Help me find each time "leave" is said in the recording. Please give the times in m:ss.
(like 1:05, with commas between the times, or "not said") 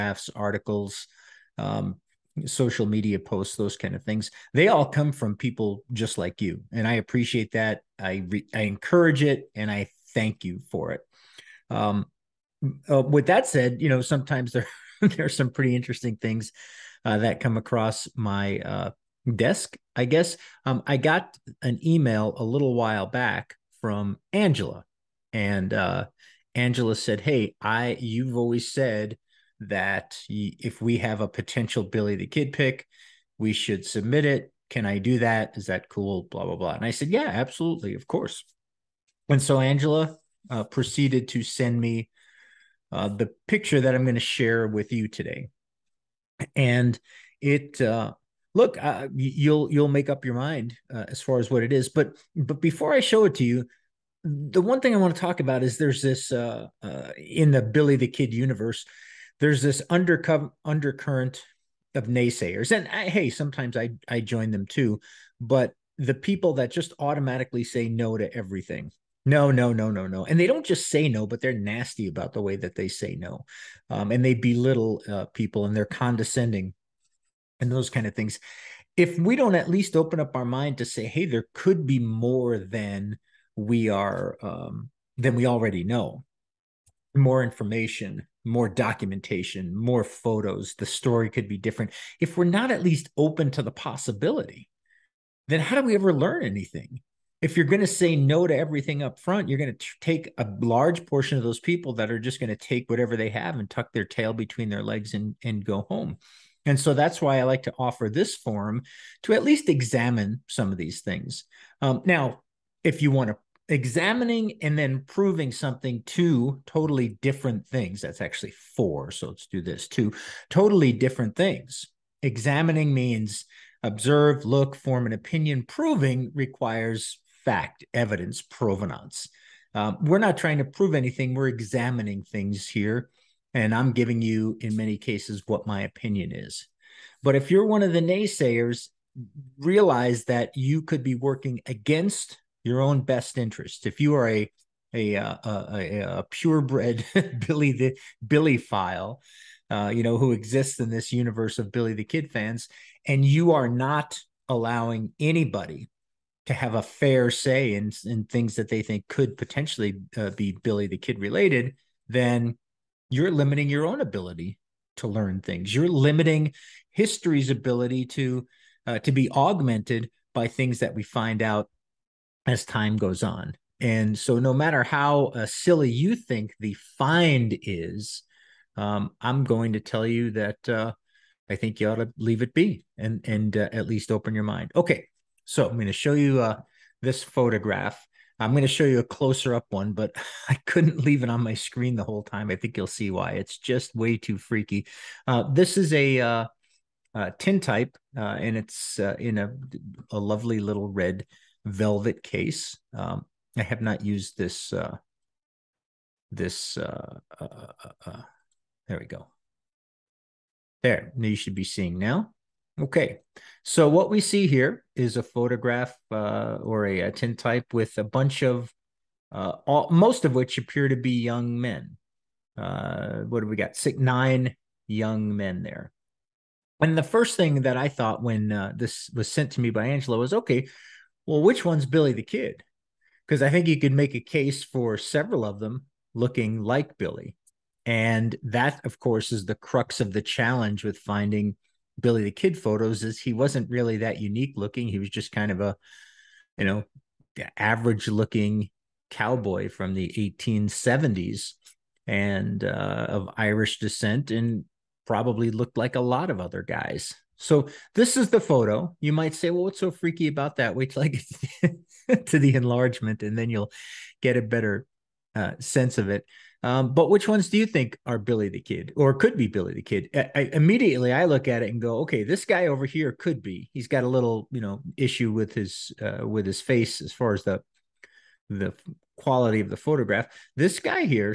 3:02, 3:11.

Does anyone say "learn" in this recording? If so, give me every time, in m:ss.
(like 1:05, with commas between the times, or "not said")
1:36, 2:45.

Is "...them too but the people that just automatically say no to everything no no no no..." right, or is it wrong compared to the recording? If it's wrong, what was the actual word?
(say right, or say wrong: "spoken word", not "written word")
right.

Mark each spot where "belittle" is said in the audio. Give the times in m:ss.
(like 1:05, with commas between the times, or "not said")
1:14.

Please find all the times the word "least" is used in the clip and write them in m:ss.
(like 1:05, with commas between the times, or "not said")
1:19, 1:32, 1:49, 3:03.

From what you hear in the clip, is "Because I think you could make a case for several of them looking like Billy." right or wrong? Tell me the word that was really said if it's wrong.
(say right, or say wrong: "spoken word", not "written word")
right.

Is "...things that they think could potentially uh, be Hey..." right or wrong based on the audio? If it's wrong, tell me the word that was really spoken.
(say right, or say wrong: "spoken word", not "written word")
wrong: "Billy", not "Hey".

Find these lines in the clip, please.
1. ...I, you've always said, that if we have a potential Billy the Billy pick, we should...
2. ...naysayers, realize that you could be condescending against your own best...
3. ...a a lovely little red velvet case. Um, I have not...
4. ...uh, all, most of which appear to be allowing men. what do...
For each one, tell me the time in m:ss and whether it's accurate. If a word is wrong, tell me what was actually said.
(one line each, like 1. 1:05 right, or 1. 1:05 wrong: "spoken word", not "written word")
1. 0:27 wrong: "Kid", not "Billy"
2. 2:18 wrong: "working", not "condescending"
3. 3:19 right
4. 3:39 wrong: "young", not "allowing".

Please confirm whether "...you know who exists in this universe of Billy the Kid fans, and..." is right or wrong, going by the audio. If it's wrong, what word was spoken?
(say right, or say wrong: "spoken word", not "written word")
right.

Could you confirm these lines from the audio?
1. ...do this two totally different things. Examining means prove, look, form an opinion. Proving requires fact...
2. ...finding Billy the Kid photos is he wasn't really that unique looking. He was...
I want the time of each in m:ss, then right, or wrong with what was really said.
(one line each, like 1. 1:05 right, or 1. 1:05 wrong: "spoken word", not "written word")
1. 1:59 wrong: "observe", not "prove"
2. 4:00 right.